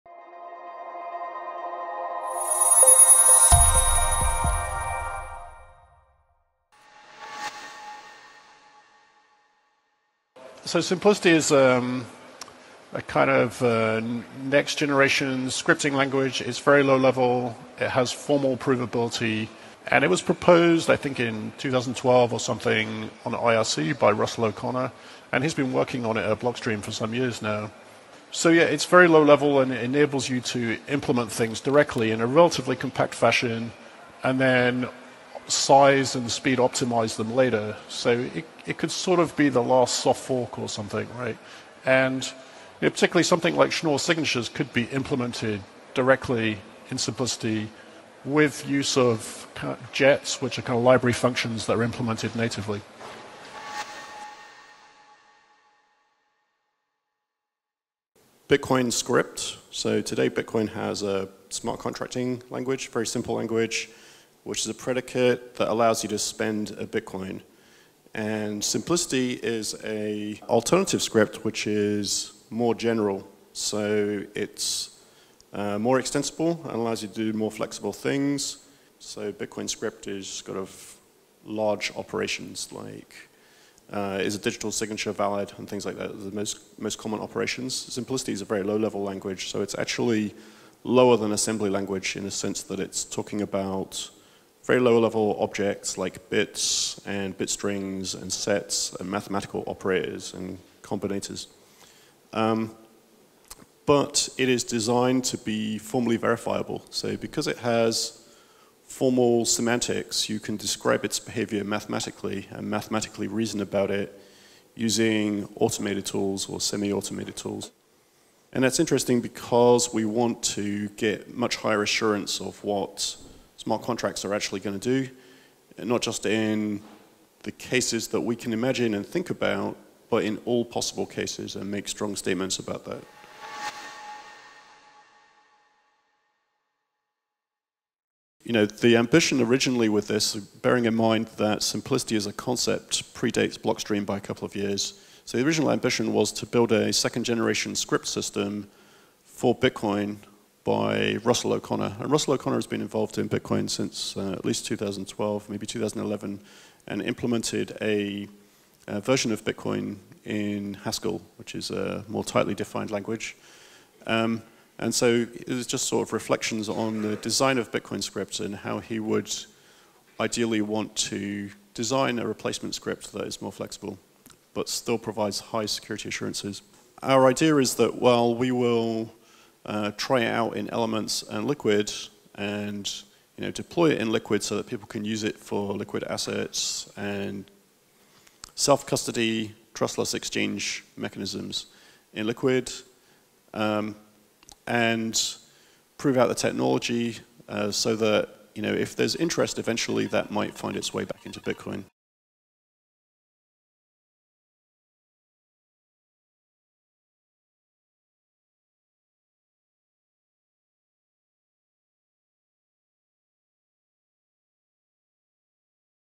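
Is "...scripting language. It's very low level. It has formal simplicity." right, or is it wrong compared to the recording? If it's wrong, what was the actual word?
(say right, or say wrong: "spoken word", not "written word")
wrong: "provability", not "simplicity".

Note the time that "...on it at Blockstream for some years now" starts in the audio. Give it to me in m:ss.
0:26.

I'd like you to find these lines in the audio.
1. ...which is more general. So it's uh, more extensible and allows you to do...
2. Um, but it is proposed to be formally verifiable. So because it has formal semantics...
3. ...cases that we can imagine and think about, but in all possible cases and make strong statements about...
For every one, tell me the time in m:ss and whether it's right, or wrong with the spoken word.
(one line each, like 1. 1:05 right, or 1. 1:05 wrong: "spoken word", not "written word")
1. 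1:11 right
2. 1:42 wrong: "designed", not "proposed"
3. 2:07 right.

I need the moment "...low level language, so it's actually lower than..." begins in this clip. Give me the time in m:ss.
1:28.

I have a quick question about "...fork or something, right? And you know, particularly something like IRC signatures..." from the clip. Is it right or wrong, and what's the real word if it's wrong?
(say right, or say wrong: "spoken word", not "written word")
wrong: "Schnorr", not "IRC".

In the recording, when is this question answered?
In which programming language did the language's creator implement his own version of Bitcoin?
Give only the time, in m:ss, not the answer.
2:40.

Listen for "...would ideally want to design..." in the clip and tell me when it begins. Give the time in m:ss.
2:48.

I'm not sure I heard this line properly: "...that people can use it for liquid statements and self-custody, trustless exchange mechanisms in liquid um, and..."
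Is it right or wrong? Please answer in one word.
wrong.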